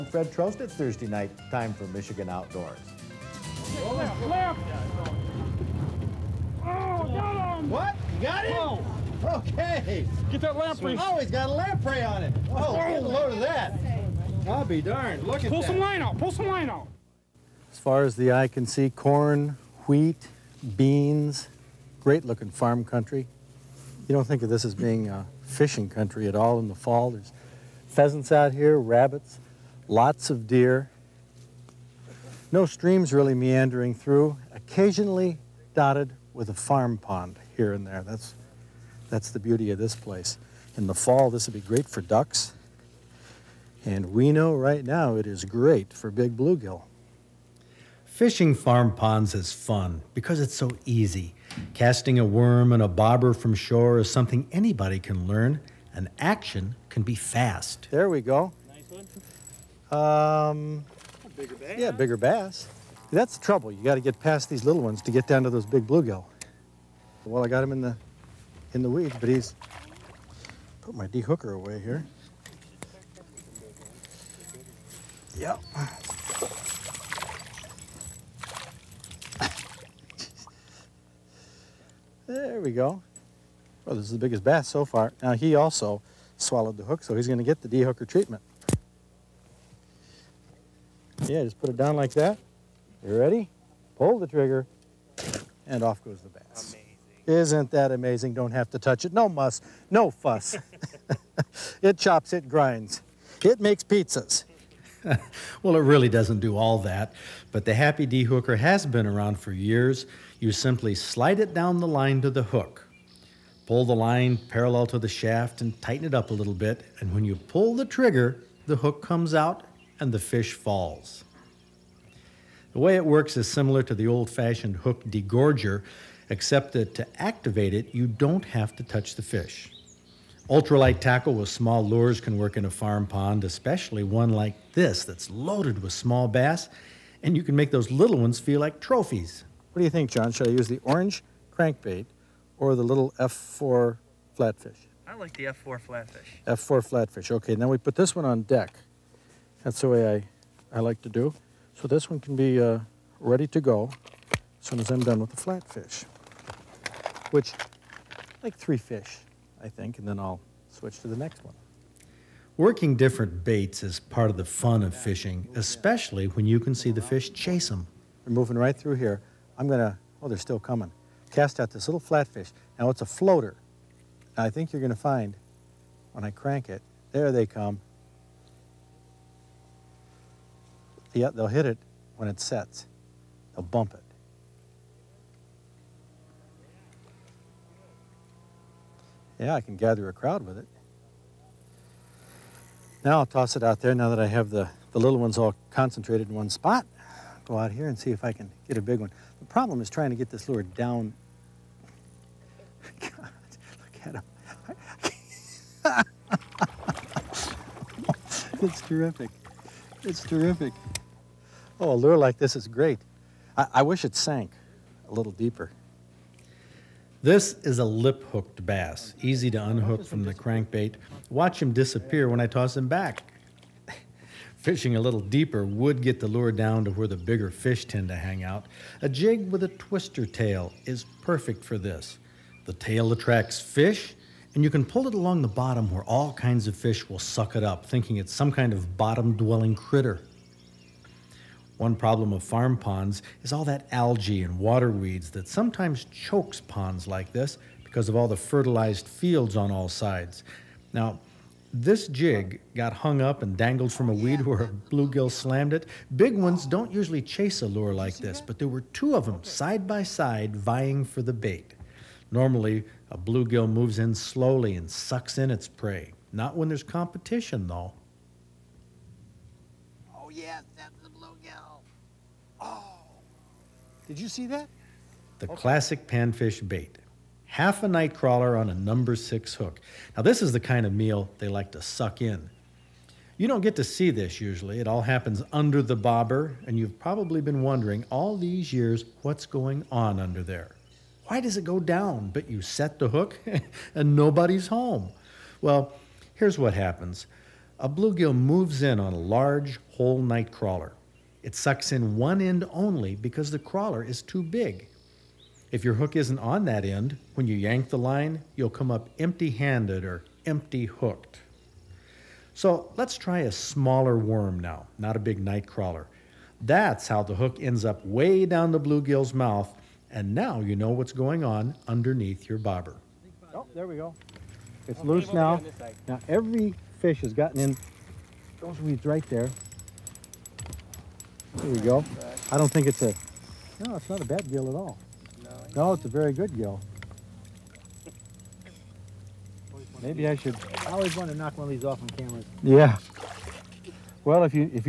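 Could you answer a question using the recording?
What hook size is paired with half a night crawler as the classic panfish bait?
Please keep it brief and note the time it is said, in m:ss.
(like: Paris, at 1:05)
number 6, at 4:38.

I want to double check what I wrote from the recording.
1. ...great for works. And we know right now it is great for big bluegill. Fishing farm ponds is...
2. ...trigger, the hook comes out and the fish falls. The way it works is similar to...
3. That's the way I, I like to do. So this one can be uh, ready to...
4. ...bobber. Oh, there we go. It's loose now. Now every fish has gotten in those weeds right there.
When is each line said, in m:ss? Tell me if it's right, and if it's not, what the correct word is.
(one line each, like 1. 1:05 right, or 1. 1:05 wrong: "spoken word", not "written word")
1. 0:41 wrong: "ducks", not "works"
2. 1:57 right
3. 2:29 right
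4. 5:22 right.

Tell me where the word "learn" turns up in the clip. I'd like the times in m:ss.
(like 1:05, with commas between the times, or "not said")
0:55.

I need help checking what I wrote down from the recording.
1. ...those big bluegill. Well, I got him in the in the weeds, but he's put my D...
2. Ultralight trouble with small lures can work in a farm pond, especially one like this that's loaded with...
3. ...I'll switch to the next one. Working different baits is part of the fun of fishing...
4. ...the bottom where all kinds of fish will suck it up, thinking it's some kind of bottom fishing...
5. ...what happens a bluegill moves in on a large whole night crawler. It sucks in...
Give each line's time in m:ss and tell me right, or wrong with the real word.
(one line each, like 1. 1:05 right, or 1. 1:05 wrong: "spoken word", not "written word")
1. 1:05 right
2. 2:10 wrong: "tackle", not "trouble"
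3. 2:40 right
4. 3:55 wrong: "dwelling", not "fishing"
5. 4:56 right.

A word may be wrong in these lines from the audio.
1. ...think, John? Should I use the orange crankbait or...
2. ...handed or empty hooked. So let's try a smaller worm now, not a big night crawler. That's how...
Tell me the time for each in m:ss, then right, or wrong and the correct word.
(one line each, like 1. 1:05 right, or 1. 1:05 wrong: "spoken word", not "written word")
1. 2:19 right
2. 5:09 right.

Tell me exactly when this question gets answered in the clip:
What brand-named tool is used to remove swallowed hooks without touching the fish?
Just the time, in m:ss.
1:47.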